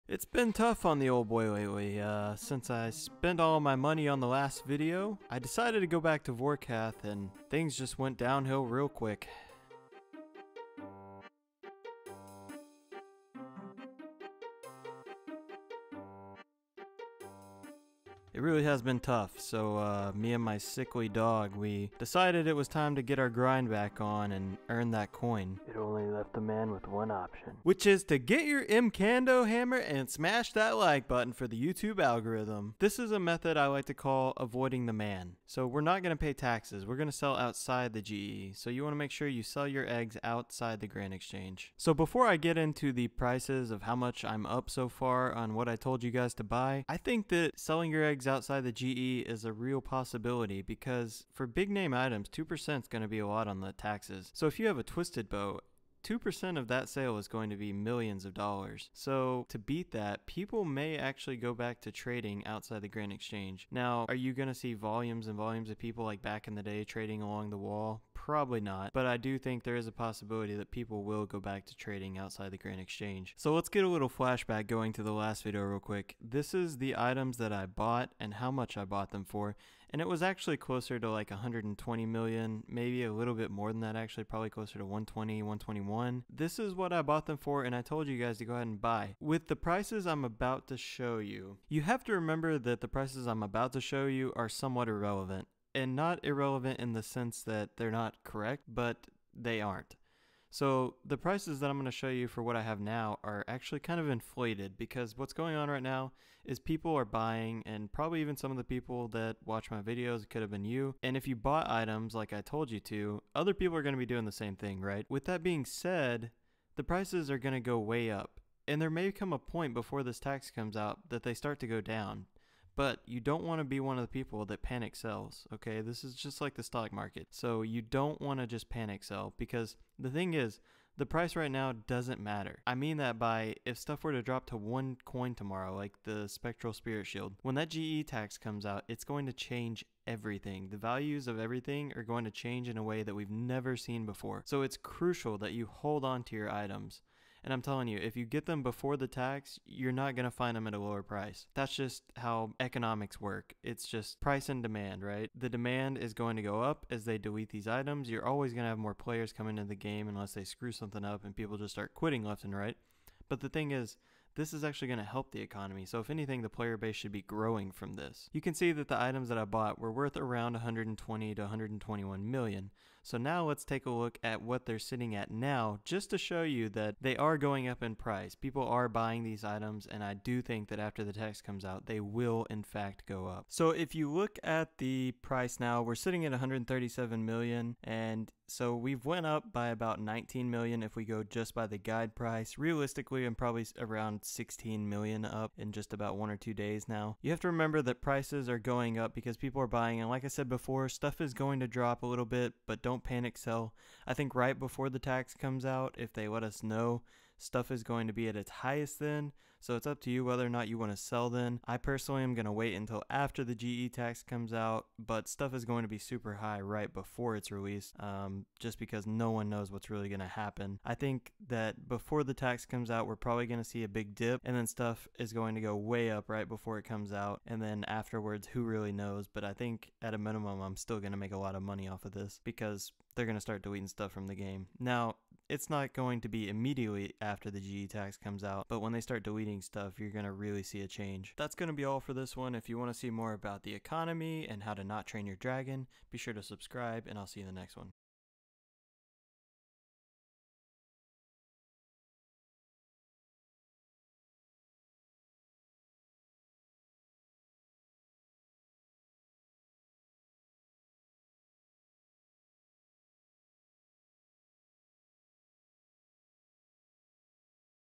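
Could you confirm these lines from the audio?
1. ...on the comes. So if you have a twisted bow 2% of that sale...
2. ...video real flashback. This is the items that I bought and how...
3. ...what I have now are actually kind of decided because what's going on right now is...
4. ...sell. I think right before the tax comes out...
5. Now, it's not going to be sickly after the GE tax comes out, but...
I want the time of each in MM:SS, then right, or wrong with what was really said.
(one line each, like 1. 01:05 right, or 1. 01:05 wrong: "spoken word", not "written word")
1. 00:53 wrong: "taxes", not "comes"
2. 01:15 wrong: "quick", not "flashback"
3. 01:42 wrong: "inflated", not "decided"
4. 03:23 right
5. 03:54 wrong: "immediately", not "sickly".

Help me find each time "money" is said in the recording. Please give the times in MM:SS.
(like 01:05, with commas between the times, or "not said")
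00:03, 03:51.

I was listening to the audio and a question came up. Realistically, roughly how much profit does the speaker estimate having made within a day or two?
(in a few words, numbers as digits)
16 million.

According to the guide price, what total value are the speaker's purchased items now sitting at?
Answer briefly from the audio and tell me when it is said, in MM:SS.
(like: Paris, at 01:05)
137 million, at 03:06.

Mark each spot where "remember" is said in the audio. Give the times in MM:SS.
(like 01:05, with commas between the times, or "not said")
01:32, 03:17.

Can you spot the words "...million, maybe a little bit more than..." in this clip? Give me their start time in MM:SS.
01:22.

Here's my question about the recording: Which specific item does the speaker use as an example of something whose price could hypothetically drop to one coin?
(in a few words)
Spectral Spirit Shield.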